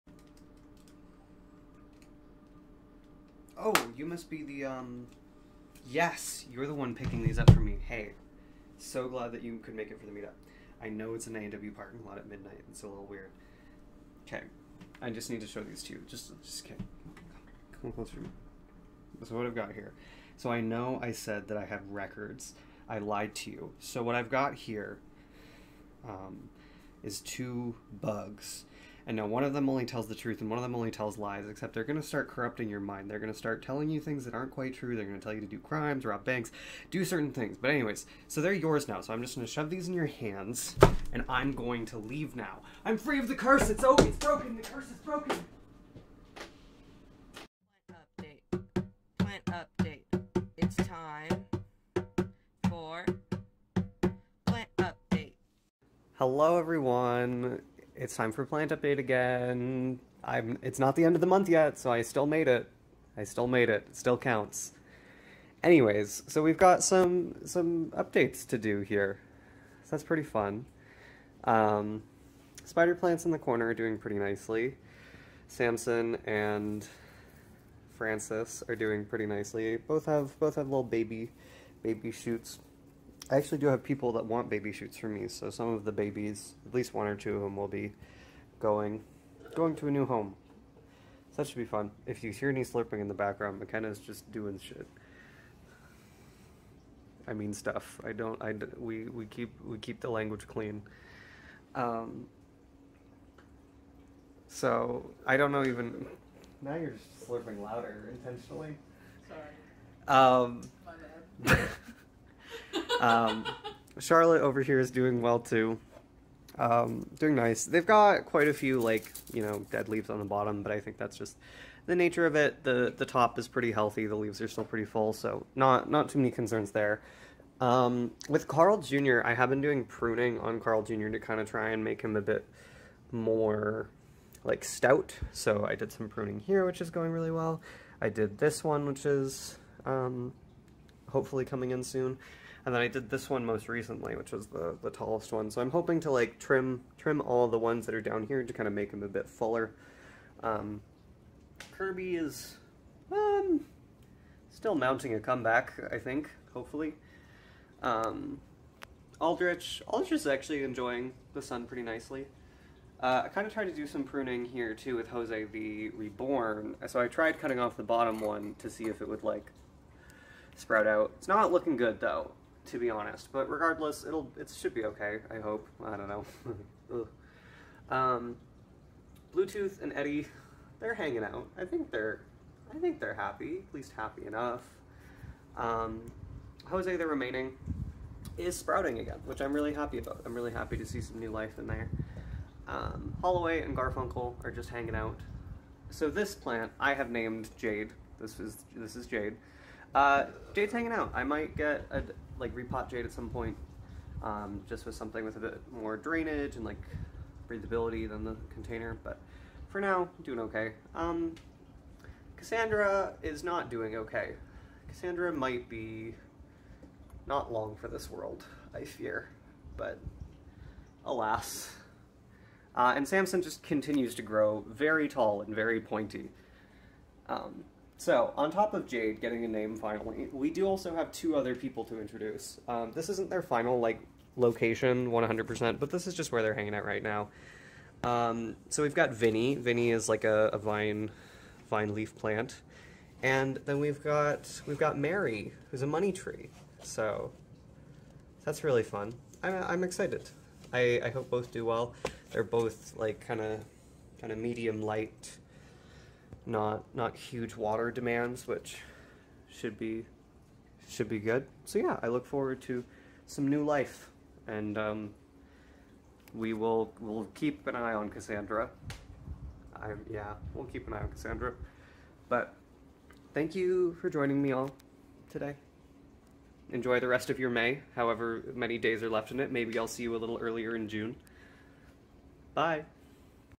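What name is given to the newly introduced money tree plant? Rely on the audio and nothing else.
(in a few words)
Mary.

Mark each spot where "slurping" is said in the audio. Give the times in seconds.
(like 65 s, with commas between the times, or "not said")
92 s, 107 s.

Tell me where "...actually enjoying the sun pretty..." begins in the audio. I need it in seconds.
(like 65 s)
160 s.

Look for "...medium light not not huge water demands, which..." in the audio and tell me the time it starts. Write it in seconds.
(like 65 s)
254 s.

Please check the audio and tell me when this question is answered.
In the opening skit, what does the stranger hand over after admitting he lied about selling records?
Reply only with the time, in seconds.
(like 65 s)
27 s.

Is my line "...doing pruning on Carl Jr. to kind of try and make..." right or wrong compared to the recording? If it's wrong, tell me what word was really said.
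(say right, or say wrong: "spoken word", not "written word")
right.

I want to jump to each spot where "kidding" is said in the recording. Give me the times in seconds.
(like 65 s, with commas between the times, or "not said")
16 s.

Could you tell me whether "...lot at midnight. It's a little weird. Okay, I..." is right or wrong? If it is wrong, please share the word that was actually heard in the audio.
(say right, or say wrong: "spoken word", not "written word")
right.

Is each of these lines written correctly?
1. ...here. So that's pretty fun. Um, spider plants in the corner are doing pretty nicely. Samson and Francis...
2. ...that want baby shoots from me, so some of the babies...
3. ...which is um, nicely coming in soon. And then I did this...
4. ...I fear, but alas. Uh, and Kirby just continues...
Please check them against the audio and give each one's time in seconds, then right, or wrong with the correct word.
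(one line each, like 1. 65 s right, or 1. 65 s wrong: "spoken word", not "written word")
1. 68 s right
2. 84 s right
3. 138 s wrong: "hopefully", not "nicely"
4. 218 s wrong: "Samson", not "Kirby".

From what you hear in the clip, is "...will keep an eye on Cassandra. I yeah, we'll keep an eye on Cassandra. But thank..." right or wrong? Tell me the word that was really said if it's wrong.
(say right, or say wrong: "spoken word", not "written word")
right.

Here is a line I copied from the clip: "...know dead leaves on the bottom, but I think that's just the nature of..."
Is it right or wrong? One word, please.
right.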